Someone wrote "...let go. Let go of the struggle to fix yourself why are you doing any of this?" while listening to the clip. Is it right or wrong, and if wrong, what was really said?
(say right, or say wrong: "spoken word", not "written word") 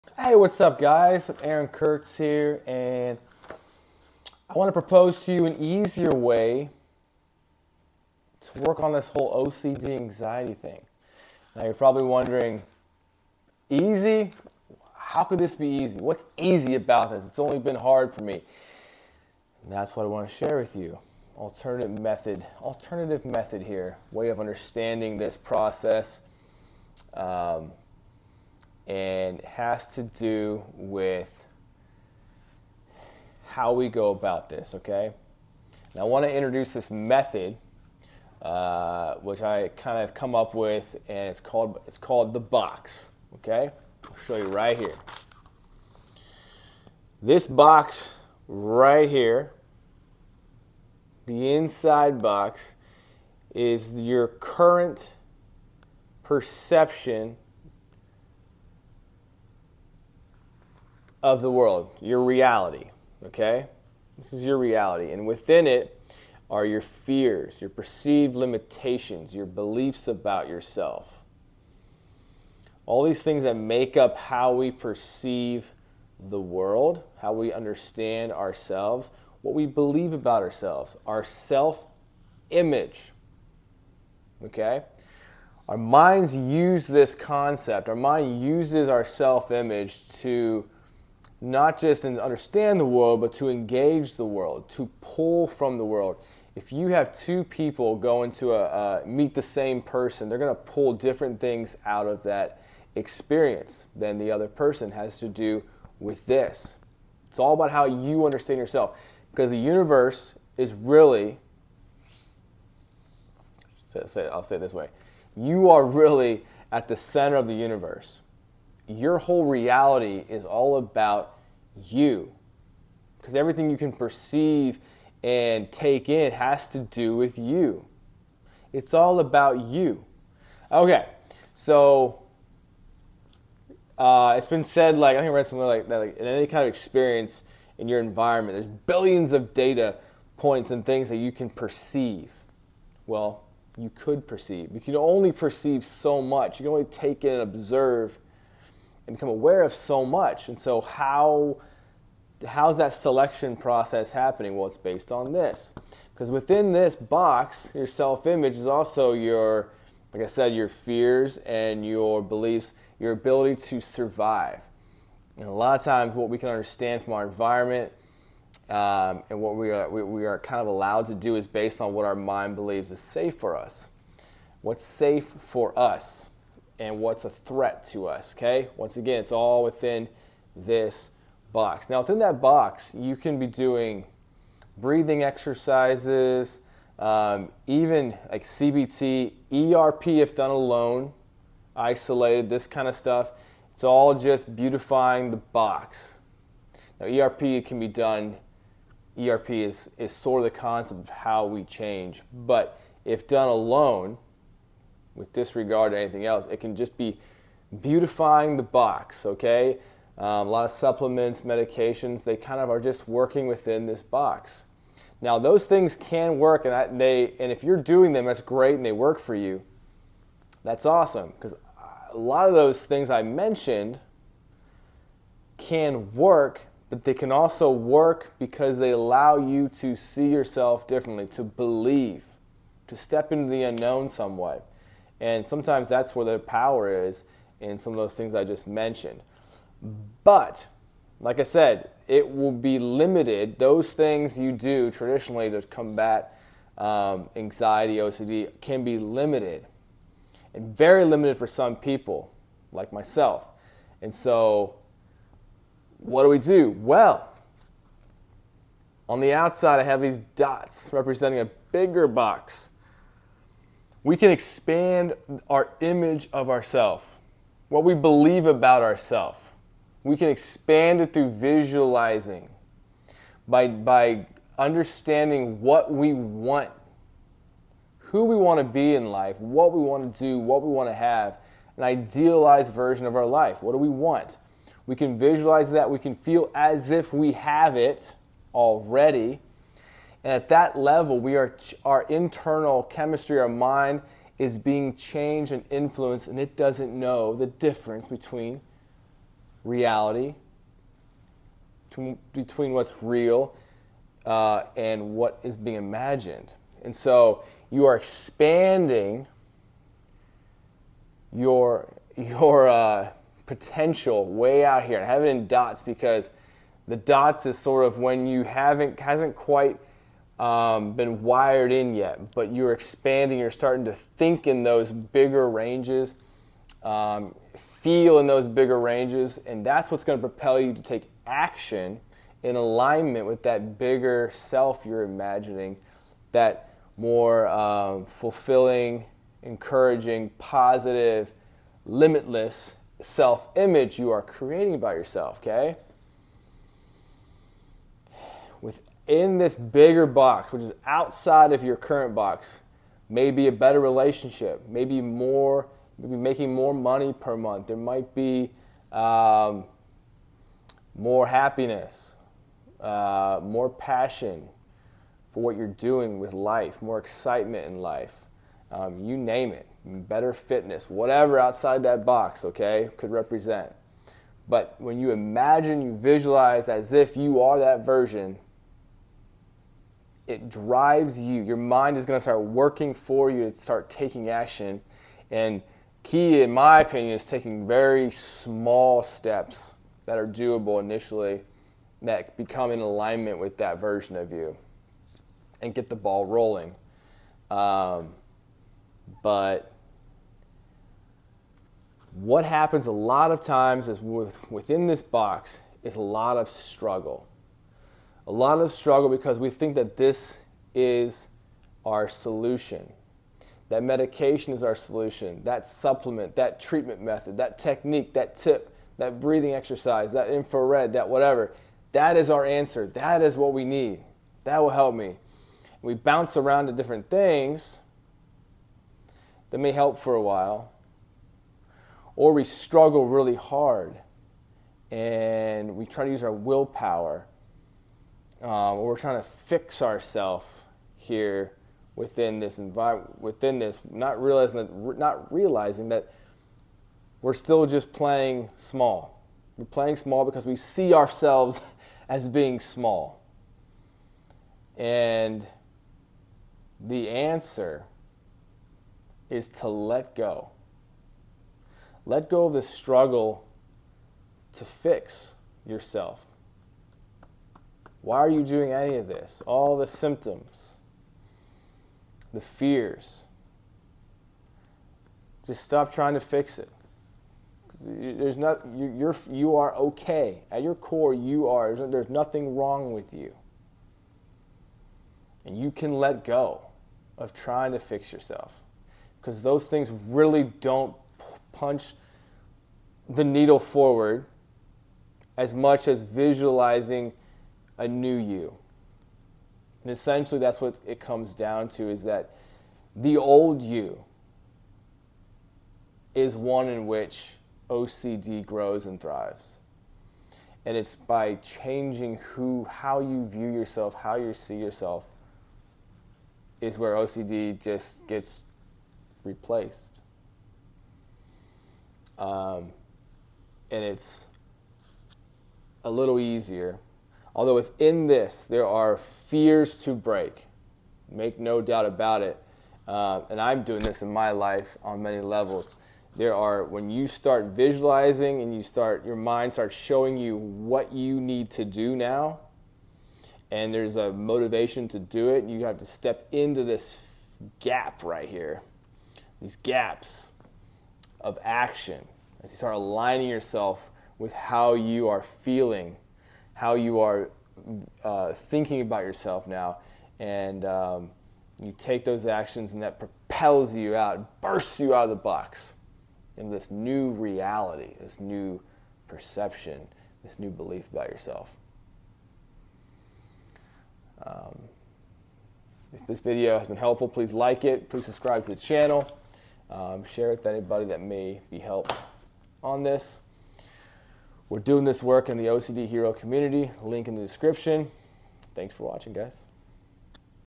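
right.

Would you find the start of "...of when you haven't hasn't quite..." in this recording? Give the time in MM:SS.
05:17.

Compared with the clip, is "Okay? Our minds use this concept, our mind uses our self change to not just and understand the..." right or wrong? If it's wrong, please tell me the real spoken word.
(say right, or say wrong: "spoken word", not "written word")
wrong: "image", not "change".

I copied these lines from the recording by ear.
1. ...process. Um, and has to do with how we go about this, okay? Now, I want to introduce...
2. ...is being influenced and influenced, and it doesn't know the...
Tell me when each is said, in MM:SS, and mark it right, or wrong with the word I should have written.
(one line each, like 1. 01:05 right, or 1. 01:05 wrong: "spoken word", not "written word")
1. 00:25 right
2. 04:54 wrong: "changed", not "influenced".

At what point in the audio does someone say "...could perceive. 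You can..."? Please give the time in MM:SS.
02:23.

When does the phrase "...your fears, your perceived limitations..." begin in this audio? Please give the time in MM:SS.
01:06.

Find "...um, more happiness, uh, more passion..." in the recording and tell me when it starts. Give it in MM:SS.
05:58.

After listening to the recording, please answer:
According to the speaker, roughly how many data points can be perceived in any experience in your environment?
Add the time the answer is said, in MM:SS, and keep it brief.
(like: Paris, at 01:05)
Billions, at 02:18.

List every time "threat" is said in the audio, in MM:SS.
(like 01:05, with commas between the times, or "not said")
02:57.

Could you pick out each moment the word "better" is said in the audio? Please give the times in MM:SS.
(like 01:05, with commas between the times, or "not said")
05:53, 06:09.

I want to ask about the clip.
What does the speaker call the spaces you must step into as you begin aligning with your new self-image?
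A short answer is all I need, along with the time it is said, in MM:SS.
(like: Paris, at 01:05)
Gaps of action, at 09:09.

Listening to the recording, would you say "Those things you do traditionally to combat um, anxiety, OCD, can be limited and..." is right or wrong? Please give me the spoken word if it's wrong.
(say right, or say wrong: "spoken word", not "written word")
right.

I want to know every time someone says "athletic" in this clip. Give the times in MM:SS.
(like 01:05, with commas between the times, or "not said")
not said.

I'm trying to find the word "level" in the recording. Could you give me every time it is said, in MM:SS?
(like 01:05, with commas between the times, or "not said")
04:50, 08:55.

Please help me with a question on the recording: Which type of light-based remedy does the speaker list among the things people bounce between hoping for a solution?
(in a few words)
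Infrared.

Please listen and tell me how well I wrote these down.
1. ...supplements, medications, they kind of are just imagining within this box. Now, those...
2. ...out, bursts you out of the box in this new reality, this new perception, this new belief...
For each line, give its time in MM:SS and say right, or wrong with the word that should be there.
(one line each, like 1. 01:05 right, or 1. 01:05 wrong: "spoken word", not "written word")
1. 03:30 wrong: "working", not "imagining"
2. 09:23 right.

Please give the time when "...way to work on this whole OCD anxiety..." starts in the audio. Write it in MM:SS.
00:06.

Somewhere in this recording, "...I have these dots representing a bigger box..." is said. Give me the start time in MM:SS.
04:19.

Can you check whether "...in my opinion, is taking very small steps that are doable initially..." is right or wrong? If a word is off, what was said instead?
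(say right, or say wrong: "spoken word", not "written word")
right.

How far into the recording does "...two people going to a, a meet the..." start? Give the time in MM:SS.
01:37.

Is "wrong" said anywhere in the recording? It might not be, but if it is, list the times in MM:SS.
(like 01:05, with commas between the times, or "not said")
08:02.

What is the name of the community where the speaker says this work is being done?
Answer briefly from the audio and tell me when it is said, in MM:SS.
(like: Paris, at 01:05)
OCD Hero, at 09:45.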